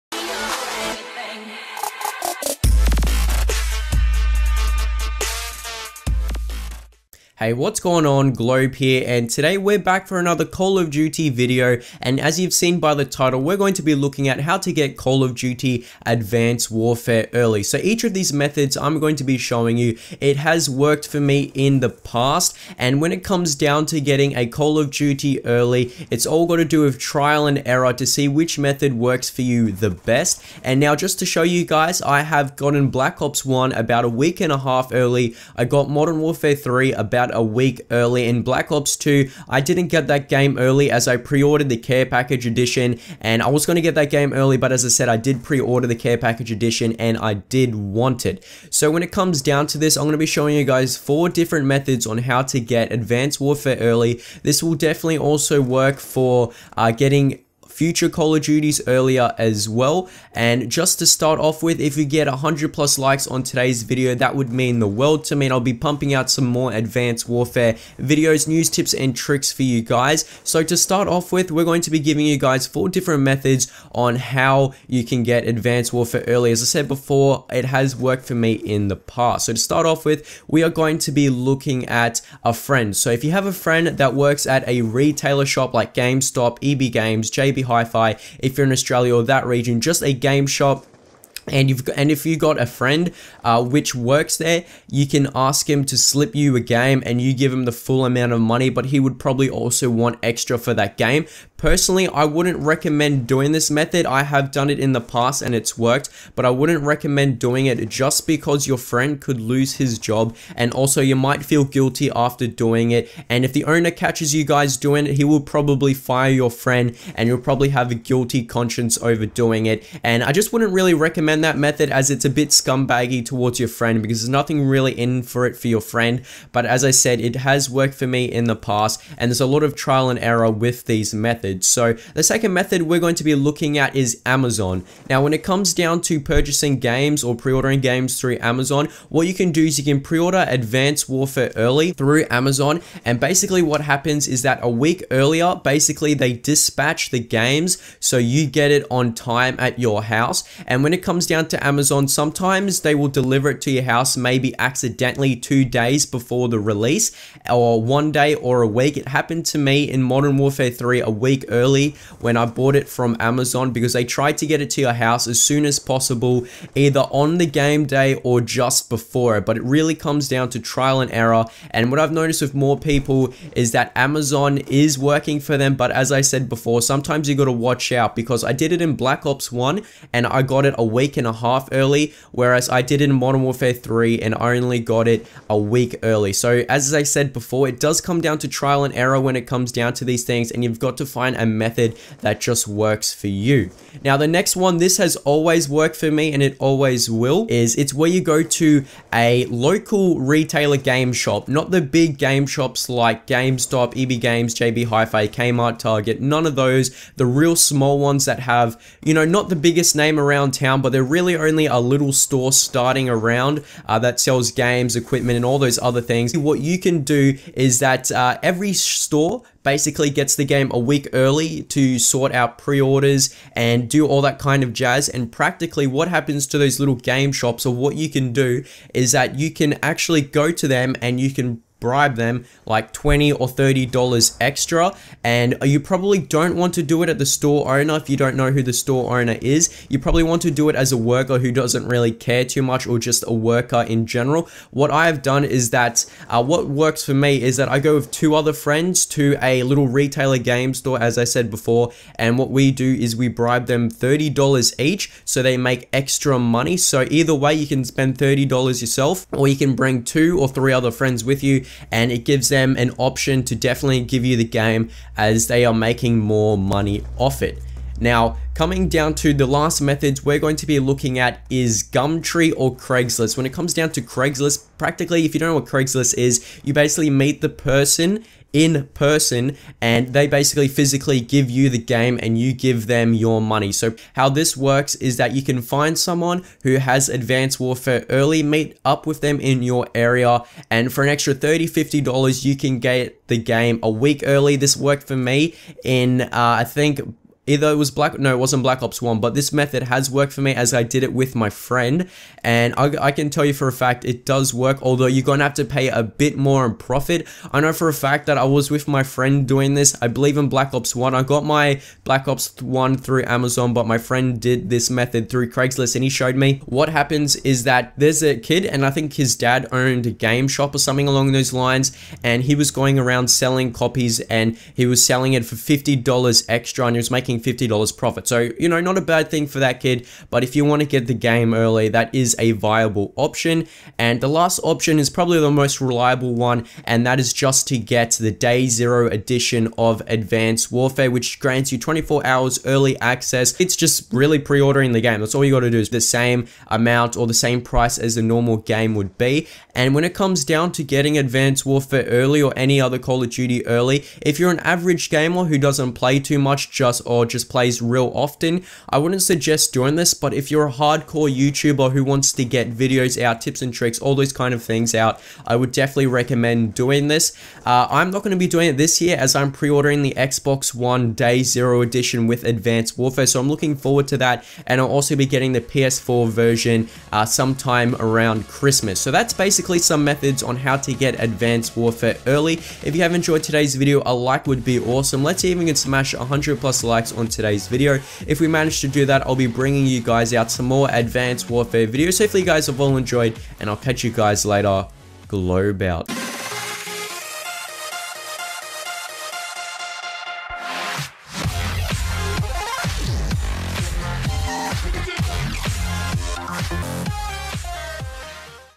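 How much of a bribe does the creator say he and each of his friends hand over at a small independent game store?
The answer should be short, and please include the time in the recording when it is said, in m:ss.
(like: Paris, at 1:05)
$30, at 4:13.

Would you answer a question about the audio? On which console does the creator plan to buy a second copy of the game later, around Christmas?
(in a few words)
PS4.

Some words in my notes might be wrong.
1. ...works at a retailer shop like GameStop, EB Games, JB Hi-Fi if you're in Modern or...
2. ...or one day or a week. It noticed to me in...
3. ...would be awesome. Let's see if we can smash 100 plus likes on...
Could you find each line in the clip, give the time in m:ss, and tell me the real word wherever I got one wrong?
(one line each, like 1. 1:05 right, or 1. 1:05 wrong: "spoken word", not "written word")
1. 1:24 wrong: "Australia", not "Modern"
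2. 2:37 wrong: "happened", not "noticed"
3. 6:24 right.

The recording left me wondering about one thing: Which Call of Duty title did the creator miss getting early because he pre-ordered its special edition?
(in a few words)
Black Ops 2.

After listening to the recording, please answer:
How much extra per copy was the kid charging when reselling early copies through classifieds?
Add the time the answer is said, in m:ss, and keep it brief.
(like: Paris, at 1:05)
$50, at 5:25.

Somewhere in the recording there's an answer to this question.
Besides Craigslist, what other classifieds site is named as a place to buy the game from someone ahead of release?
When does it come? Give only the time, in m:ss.
4:31.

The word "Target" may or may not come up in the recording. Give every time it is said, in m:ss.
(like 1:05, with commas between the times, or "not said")
3:25.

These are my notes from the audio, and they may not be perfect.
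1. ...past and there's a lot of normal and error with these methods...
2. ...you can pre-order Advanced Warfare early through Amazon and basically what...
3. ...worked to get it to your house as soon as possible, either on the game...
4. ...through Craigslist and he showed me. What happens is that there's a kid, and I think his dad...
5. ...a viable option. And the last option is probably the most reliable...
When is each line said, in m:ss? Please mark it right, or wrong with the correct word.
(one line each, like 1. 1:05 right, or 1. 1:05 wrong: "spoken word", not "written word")
1. 2:08 wrong: "trial", not "normal"
2. 2:19 right
3. 2:44 wrong: "tried", not "worked"
4. 5:15 right
5. 5:32 right.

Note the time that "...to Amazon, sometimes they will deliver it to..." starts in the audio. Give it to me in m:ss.
2:31.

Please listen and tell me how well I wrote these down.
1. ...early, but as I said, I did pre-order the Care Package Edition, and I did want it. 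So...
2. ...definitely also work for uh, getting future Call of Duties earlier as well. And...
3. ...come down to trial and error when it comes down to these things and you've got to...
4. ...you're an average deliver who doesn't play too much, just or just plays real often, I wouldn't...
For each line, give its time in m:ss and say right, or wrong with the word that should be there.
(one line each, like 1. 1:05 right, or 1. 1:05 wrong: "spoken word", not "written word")
1. 0:44 right
2. 0:54 right
3. 3:08 right
4. 5:54 wrong: "gamer", not "deliver".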